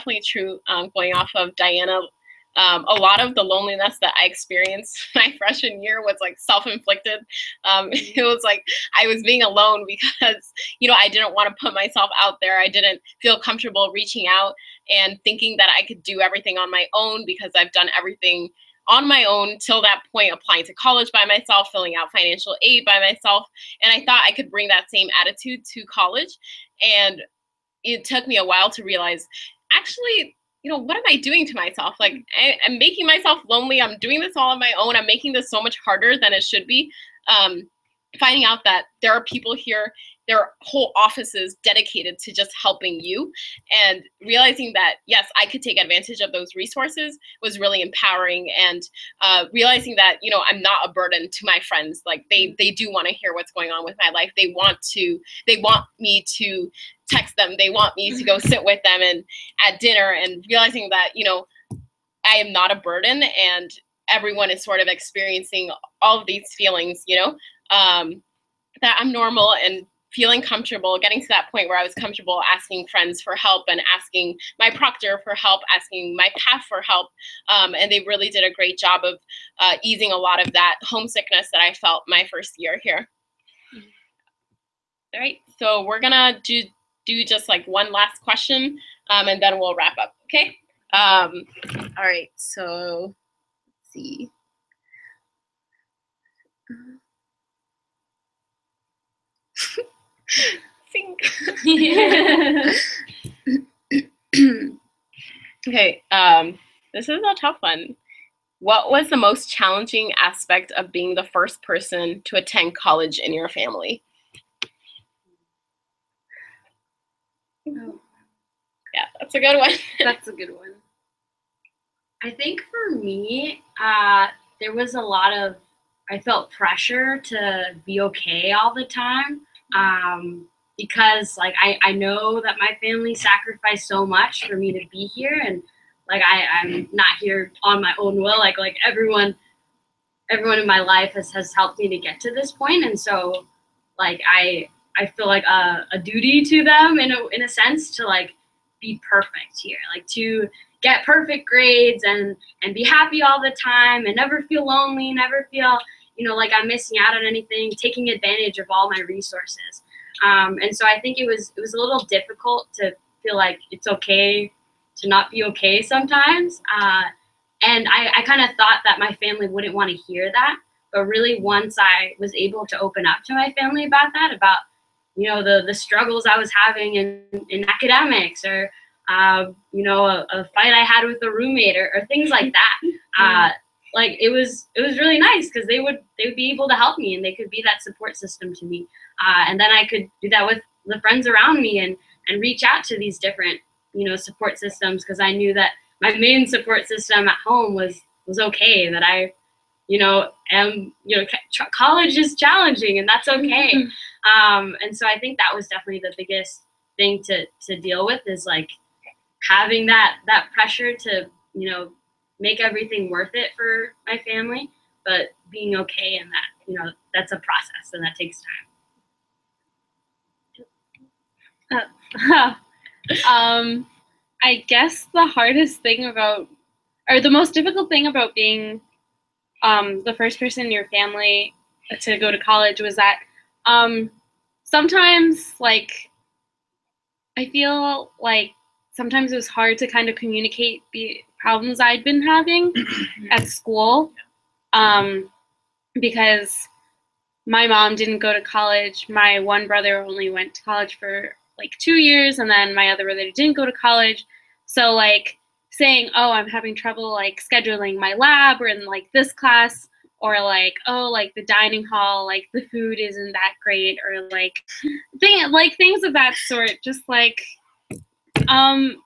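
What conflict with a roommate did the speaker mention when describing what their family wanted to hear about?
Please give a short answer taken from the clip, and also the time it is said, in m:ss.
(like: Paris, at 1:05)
a fight, at 3:00.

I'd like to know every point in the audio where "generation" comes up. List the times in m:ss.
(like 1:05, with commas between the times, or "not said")
not said.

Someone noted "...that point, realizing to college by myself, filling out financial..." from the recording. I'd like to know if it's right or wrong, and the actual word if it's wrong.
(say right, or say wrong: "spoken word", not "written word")
wrong: "applying", not "realizing".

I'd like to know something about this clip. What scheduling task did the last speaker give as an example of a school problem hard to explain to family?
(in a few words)
scheduling my lab.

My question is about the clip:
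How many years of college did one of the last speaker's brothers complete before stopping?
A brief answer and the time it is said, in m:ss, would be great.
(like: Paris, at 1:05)
2, at 4:11.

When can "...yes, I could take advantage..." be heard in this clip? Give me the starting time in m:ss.
0:45.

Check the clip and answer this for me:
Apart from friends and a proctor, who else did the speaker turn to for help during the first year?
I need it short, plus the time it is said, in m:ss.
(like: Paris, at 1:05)
PAF, at 1:16.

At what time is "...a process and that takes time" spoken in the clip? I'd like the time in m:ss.
3:37.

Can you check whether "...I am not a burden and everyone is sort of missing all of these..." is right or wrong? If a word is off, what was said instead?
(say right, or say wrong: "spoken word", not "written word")
wrong: "experiencing", not "missing".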